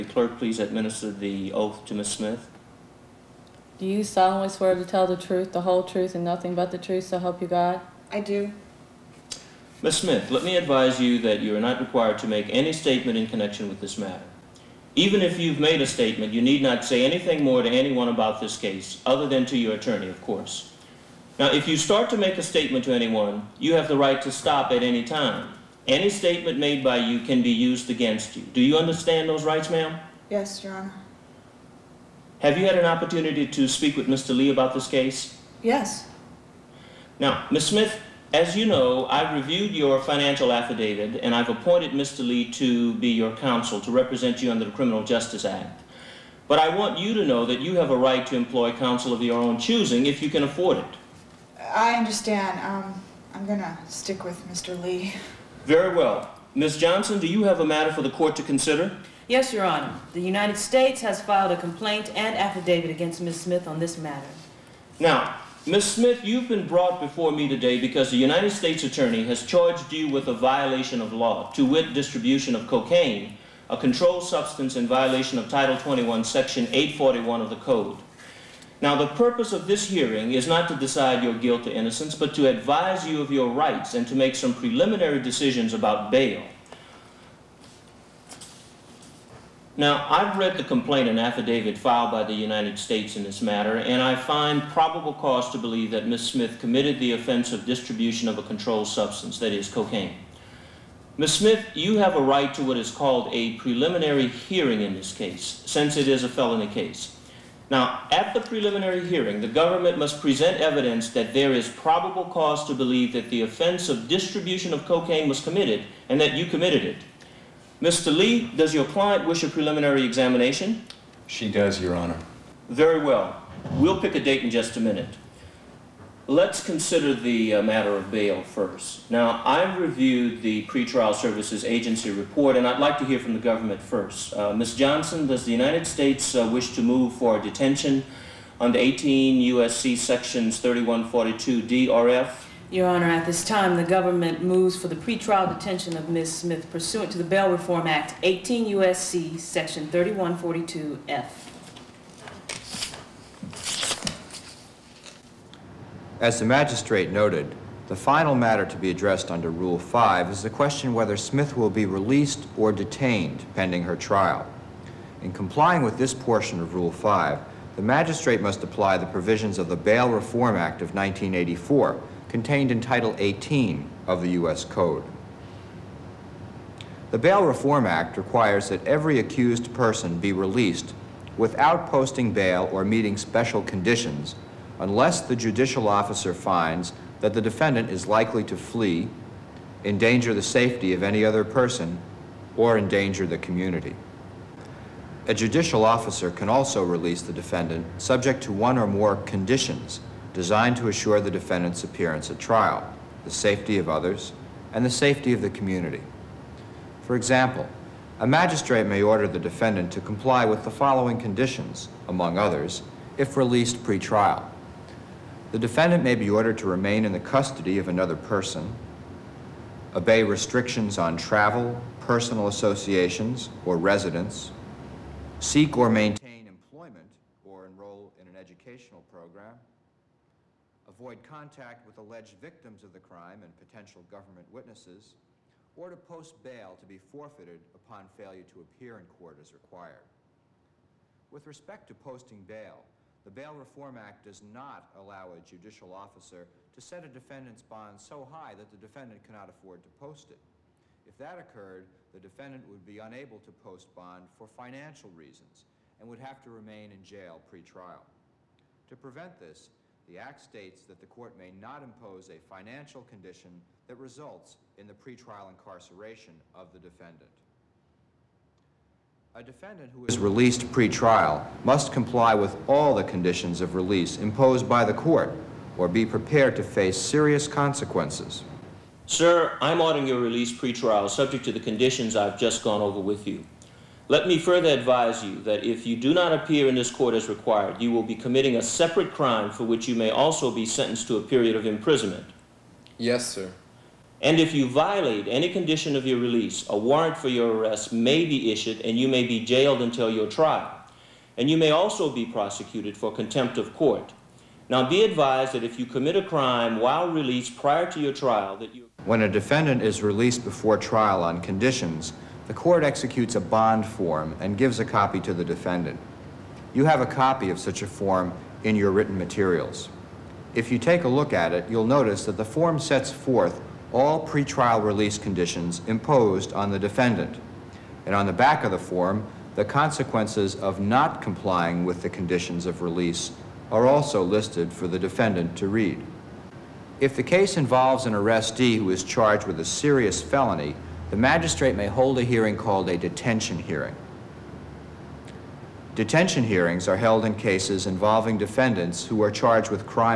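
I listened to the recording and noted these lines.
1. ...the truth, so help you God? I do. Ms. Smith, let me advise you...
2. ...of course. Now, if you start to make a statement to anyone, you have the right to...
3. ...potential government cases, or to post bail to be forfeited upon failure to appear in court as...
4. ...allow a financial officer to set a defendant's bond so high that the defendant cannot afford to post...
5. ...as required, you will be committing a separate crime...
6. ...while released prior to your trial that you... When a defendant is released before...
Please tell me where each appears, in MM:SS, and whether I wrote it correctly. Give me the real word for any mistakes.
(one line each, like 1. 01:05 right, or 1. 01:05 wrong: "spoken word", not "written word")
1. 00:06 right
2. 00:20 right
3. 03:53 wrong: "witnesses", not "cases"
4. 04:04 wrong: "judicial", not "financial"
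5. 04:47 right
6. 05:06 right.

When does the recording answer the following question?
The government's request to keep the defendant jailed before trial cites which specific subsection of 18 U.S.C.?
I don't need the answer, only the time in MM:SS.
02:29.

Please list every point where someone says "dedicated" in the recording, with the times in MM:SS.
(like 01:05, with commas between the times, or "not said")
not said.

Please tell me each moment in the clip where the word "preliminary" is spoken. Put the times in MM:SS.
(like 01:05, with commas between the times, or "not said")
01:24, 01:43, 01:48, 01:59.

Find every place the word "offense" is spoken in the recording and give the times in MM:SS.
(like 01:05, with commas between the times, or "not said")
01:37, 01:53.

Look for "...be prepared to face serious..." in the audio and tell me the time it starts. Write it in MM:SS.
04:35.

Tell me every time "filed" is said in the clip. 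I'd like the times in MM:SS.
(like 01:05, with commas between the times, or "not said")
01:01, 01:31.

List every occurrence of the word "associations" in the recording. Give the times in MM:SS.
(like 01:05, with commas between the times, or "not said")
03:42.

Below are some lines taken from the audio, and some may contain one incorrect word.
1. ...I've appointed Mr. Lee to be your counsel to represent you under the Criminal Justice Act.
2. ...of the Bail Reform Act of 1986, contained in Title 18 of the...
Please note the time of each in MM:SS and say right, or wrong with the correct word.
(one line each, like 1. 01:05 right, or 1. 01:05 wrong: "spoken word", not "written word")
1. 00:41 right
2. 02:49 wrong: "1984", not "1986".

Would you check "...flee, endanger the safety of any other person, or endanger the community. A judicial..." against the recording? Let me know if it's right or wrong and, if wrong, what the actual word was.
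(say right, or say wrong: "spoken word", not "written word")
right.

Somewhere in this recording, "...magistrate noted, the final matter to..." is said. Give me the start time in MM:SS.
02:36.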